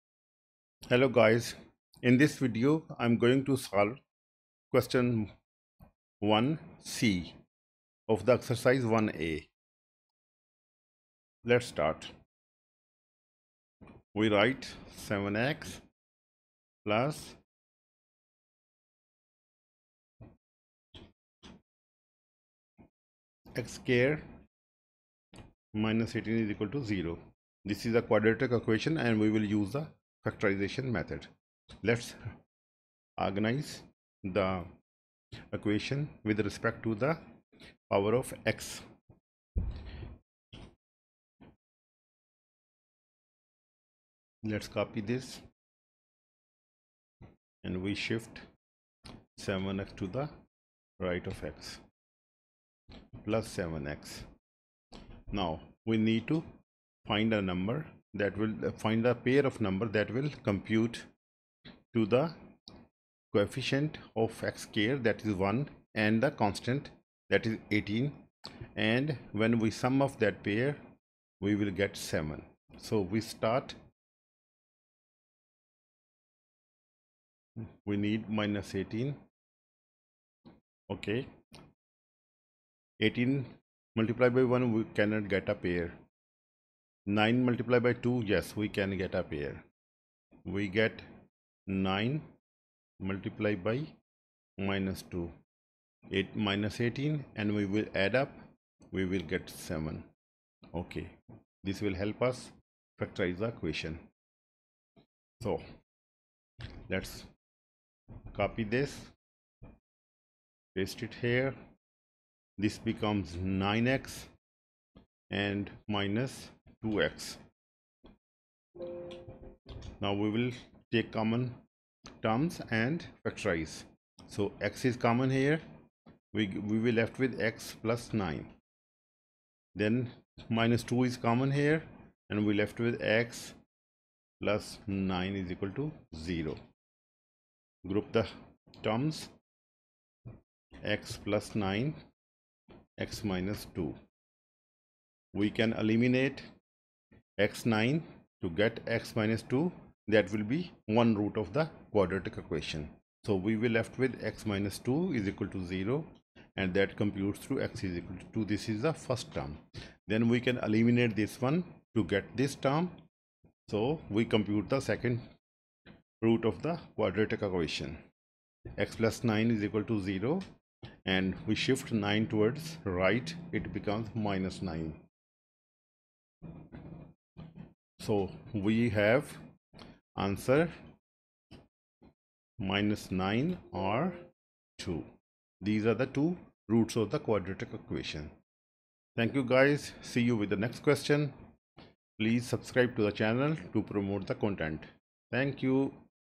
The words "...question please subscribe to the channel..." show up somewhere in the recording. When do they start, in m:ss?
3:10.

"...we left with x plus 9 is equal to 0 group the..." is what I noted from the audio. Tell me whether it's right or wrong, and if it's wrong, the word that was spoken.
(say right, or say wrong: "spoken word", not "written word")
right.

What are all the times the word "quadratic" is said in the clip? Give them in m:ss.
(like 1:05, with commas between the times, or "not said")
0:28, 2:31, 2:46, 3:07.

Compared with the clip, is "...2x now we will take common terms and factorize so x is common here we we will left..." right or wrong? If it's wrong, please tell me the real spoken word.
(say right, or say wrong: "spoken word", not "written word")
right.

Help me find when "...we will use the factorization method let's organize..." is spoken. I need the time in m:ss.
0:29.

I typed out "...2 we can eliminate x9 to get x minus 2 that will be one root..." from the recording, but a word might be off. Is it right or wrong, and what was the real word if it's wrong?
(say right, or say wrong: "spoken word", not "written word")
right.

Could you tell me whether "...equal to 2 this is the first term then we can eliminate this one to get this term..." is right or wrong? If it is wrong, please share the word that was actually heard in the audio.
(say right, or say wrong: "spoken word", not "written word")
right.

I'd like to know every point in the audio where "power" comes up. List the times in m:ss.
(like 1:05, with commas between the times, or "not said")
0:37.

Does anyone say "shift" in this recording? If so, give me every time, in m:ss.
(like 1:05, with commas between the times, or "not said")
0:47, 2:51.